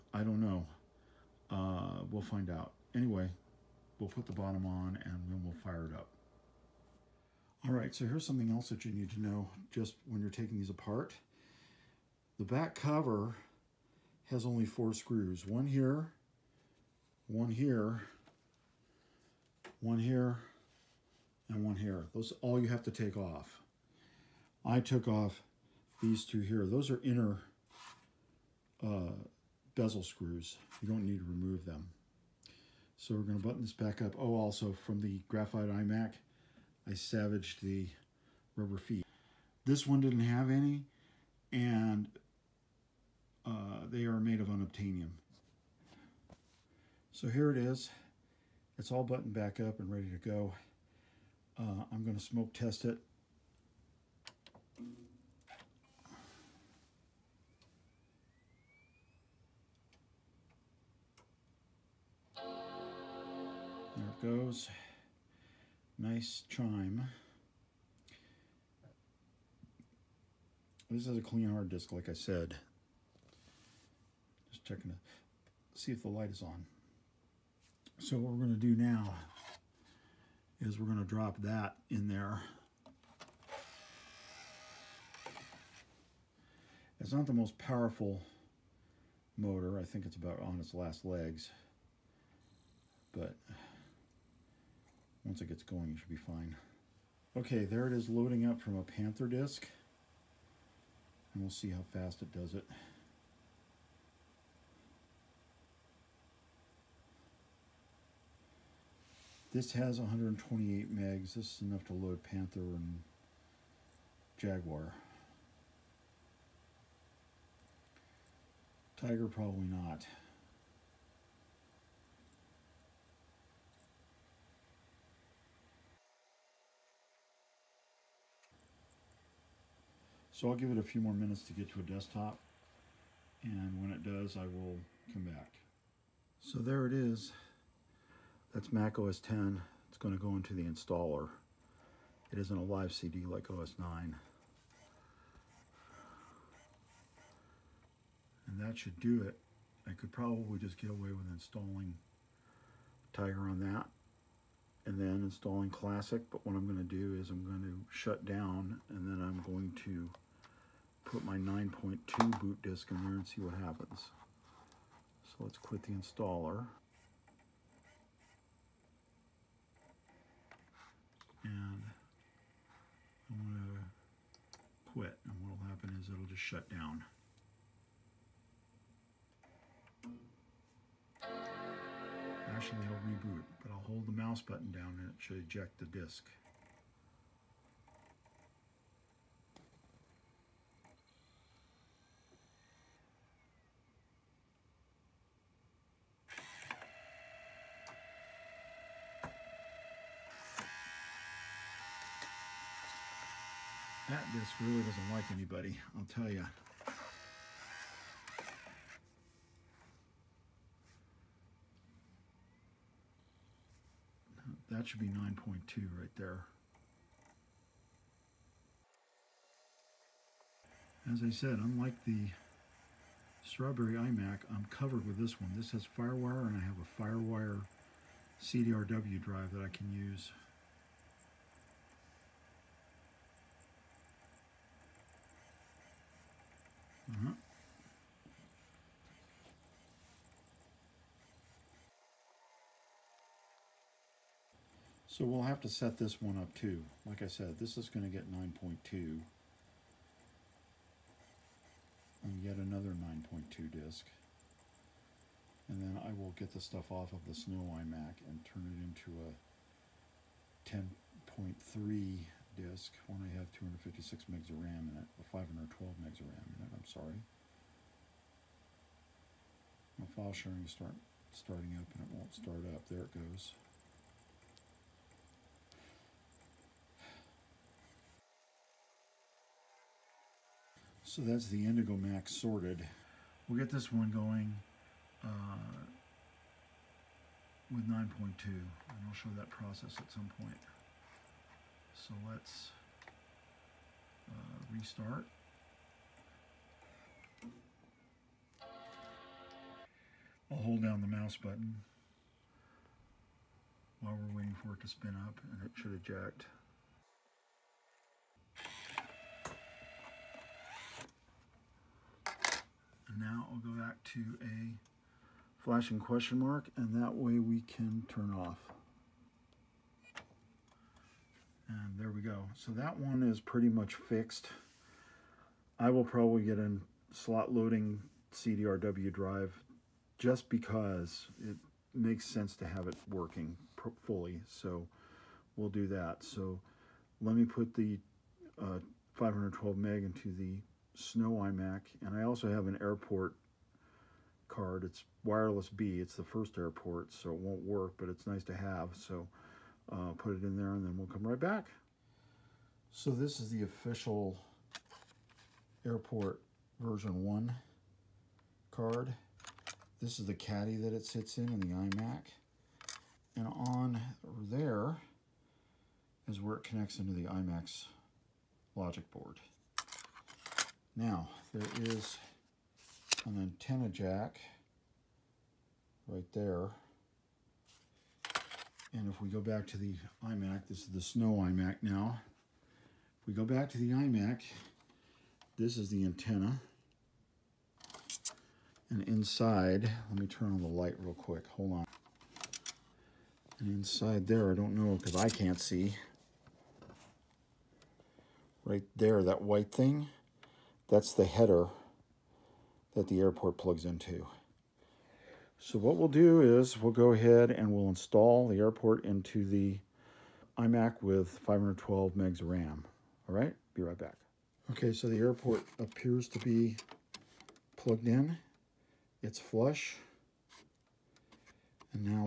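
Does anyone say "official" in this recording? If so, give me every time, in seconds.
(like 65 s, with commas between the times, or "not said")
353 s.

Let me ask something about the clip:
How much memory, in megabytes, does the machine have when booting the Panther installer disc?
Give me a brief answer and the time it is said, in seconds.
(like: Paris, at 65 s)
128, at 109 s.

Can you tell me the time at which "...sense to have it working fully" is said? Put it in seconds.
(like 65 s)
332 s.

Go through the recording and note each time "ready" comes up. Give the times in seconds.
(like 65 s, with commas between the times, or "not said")
49 s.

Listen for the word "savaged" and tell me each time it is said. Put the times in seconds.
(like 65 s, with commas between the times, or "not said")
36 s.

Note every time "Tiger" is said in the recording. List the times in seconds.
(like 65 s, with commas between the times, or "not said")
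118 s, 153 s.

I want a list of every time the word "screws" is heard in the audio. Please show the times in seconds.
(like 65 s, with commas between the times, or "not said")
14 s, 30 s.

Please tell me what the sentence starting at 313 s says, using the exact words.
now I'll go back to a flashing question mark and that way we can turn off.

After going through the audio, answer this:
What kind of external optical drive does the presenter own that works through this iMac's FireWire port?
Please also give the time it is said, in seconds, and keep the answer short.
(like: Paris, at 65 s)
FireWire CDRW drive, at 227 s.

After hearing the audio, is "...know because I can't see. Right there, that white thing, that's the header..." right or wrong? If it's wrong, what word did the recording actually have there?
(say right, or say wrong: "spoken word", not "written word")
right.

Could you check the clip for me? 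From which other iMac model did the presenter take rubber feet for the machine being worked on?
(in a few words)
graphite iMac.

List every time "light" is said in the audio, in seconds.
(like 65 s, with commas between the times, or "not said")
76 s, 390 s.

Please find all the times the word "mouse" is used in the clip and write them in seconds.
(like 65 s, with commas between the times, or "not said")
184 s, 301 s.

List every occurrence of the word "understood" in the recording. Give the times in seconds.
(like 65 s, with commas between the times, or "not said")
not said.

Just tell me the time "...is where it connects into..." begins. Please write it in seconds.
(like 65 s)
366 s.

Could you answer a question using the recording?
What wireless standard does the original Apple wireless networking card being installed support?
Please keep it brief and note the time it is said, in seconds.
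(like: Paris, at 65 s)
wireless B, at 345 s.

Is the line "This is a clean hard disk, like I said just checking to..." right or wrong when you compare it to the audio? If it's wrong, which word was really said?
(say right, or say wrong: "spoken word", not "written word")
right.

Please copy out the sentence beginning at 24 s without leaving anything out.
I took off these two here.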